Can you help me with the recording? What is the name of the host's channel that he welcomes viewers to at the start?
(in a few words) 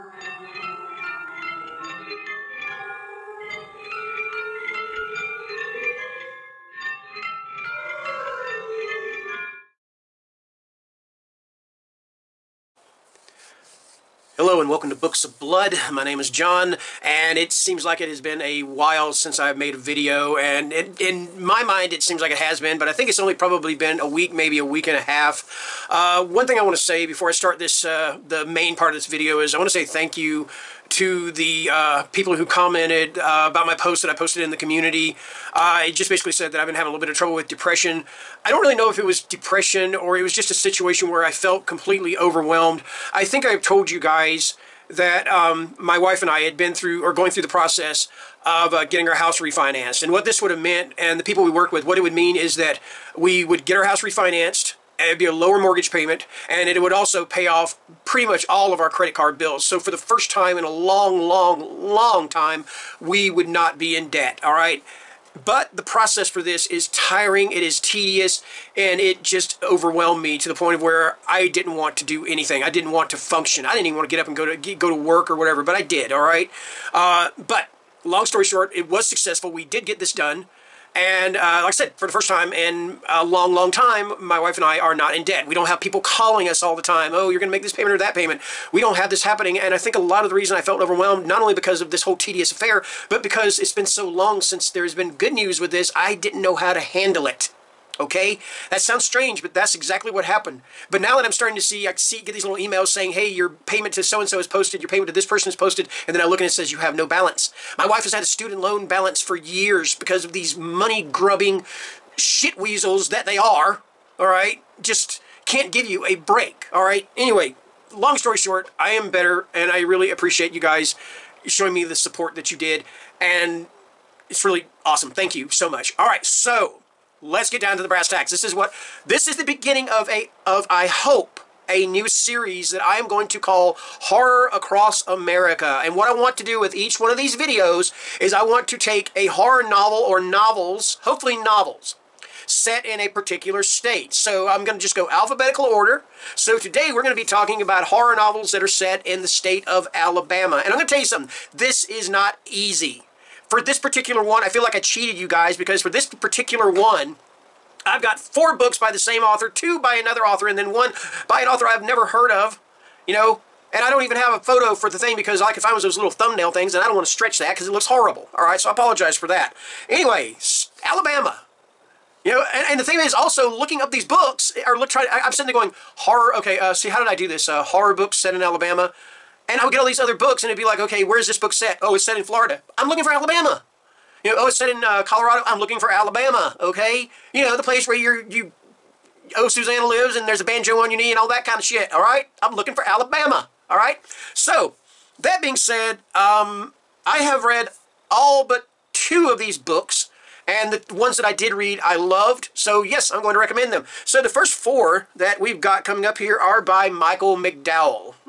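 Books of Blood.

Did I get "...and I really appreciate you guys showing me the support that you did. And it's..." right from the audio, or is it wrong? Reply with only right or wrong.
right.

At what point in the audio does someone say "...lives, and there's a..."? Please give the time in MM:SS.
03:09.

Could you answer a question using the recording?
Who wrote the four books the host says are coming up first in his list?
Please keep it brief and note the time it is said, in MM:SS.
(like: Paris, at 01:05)
Michael McDowell, at 03:26.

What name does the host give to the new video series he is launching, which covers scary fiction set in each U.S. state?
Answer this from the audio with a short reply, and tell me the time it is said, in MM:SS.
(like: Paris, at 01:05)
Horror Across America, at 02:13.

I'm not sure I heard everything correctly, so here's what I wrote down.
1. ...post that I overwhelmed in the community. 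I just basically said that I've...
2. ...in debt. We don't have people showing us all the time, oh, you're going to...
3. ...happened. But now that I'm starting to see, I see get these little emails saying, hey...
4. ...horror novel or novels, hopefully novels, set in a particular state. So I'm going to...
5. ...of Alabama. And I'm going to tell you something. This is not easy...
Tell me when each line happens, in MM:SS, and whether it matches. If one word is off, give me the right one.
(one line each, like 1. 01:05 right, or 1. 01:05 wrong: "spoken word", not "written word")
1. 00:33 wrong: "posted", not "overwhelmed"
2. 01:25 wrong: "calling", not "showing"
3. 01:40 right
4. 02:19 right
5. 02:29 right.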